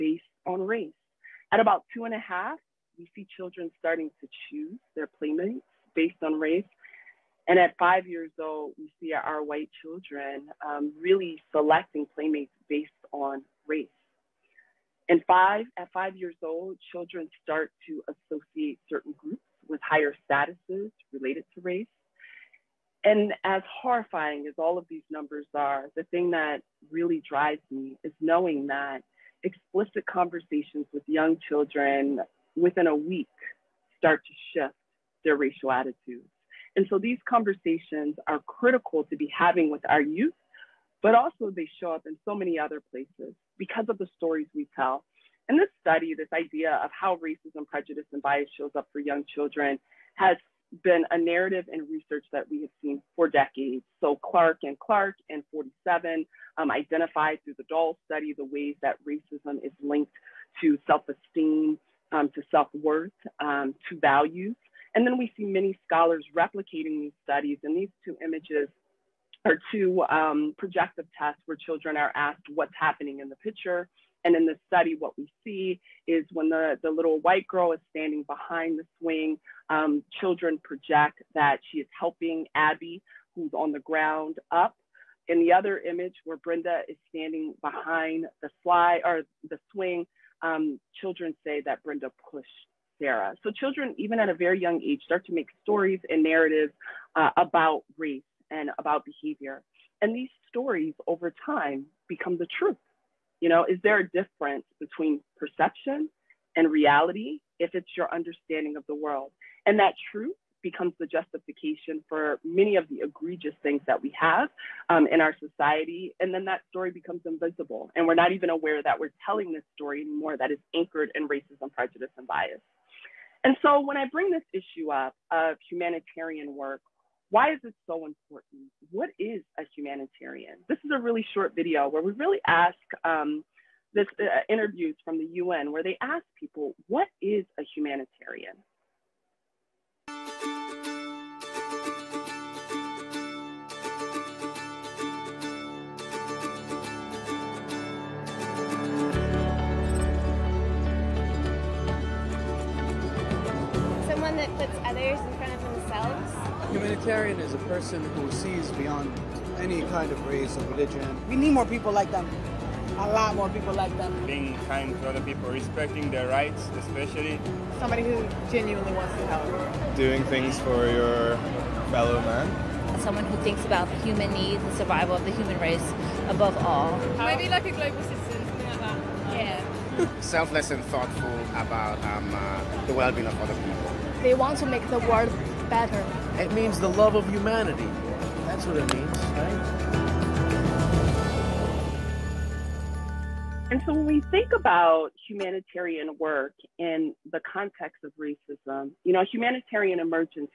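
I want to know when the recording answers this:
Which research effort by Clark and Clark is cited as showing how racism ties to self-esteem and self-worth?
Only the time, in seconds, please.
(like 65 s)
57 s.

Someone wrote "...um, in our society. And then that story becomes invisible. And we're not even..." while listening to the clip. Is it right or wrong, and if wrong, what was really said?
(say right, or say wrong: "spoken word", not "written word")
right.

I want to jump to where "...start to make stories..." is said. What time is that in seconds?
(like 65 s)
95 s.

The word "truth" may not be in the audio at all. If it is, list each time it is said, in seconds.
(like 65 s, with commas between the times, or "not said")
102 s, 110 s.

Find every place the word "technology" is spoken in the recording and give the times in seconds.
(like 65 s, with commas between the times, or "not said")
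not said.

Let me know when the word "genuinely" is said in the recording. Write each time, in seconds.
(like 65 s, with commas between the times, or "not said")
168 s.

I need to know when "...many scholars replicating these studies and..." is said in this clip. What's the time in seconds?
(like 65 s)
65 s.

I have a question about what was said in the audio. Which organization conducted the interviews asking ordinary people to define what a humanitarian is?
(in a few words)
UN.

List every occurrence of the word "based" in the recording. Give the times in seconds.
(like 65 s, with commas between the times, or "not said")
5 s, 12 s.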